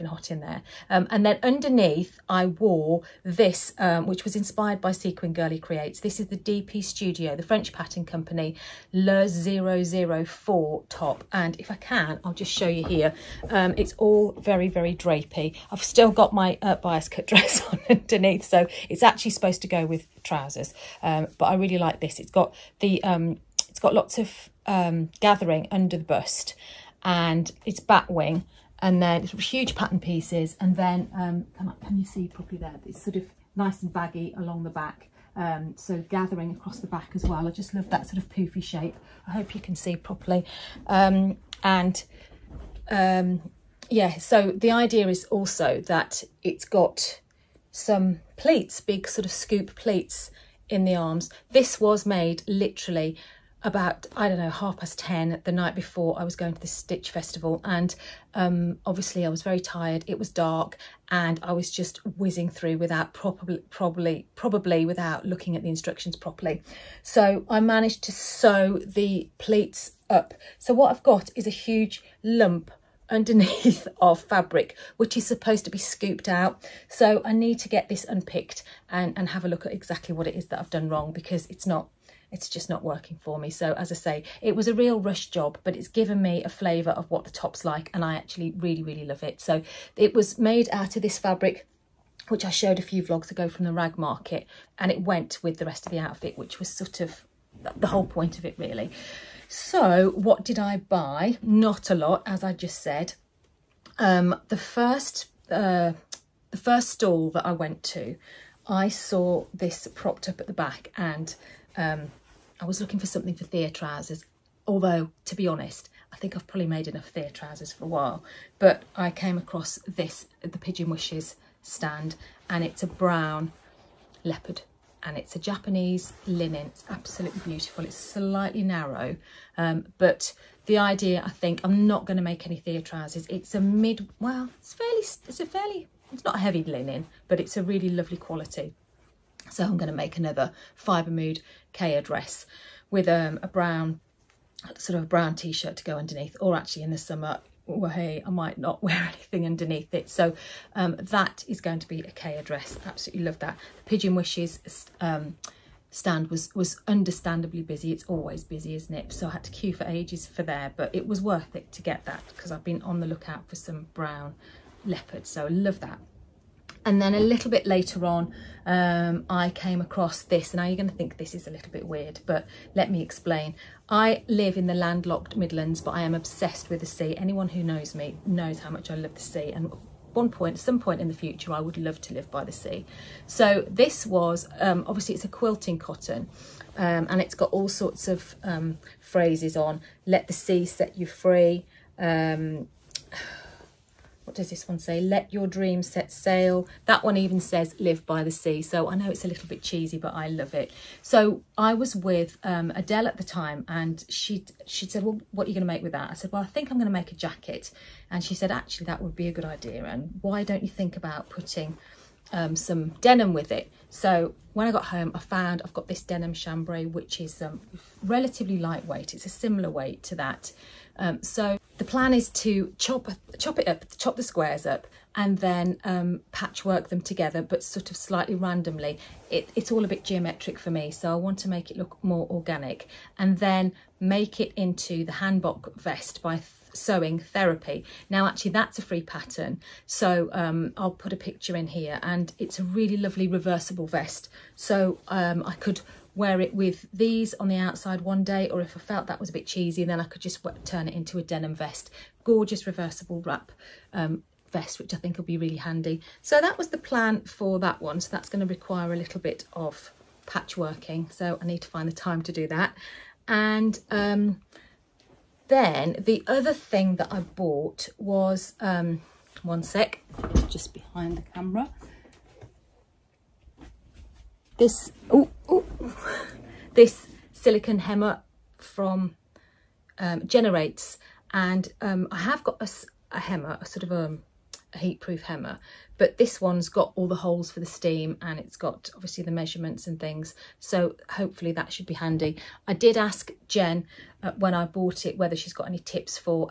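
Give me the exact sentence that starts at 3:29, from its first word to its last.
And why don't you think about putting um, some denim with it?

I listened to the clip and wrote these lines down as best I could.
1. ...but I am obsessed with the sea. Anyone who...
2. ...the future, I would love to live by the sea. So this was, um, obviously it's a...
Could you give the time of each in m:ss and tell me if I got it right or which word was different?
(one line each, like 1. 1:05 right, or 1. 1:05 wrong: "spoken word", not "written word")
1. 2:55 right
2. 3:01 right.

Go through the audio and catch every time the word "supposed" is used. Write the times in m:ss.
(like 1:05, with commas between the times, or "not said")
0:19, 1:15.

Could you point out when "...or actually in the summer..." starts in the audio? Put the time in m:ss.
2:26.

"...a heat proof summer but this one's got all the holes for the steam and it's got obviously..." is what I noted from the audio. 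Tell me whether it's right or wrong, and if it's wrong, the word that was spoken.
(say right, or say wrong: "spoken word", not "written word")
wrong: "hemmer", not "summer".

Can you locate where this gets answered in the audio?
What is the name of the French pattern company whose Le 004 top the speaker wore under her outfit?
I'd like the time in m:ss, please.
0:06.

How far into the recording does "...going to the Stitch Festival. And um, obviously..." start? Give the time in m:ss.
0:56.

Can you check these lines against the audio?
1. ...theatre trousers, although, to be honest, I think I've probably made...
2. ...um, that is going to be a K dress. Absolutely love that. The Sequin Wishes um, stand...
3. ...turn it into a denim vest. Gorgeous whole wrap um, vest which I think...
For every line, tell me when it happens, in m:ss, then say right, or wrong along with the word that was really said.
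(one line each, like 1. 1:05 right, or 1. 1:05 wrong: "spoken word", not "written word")
1. 1:53 right
2. 2:30 wrong: "Pigeon", not "Sequin"
3. 4:10 wrong: "reversible", not "whole".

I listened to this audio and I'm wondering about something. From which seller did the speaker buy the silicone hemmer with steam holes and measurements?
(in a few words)
Jenerates.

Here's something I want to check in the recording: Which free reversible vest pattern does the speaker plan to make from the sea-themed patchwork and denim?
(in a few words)
Hanbok vest.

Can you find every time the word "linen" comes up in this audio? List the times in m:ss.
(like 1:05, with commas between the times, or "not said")
2:06, 2:16.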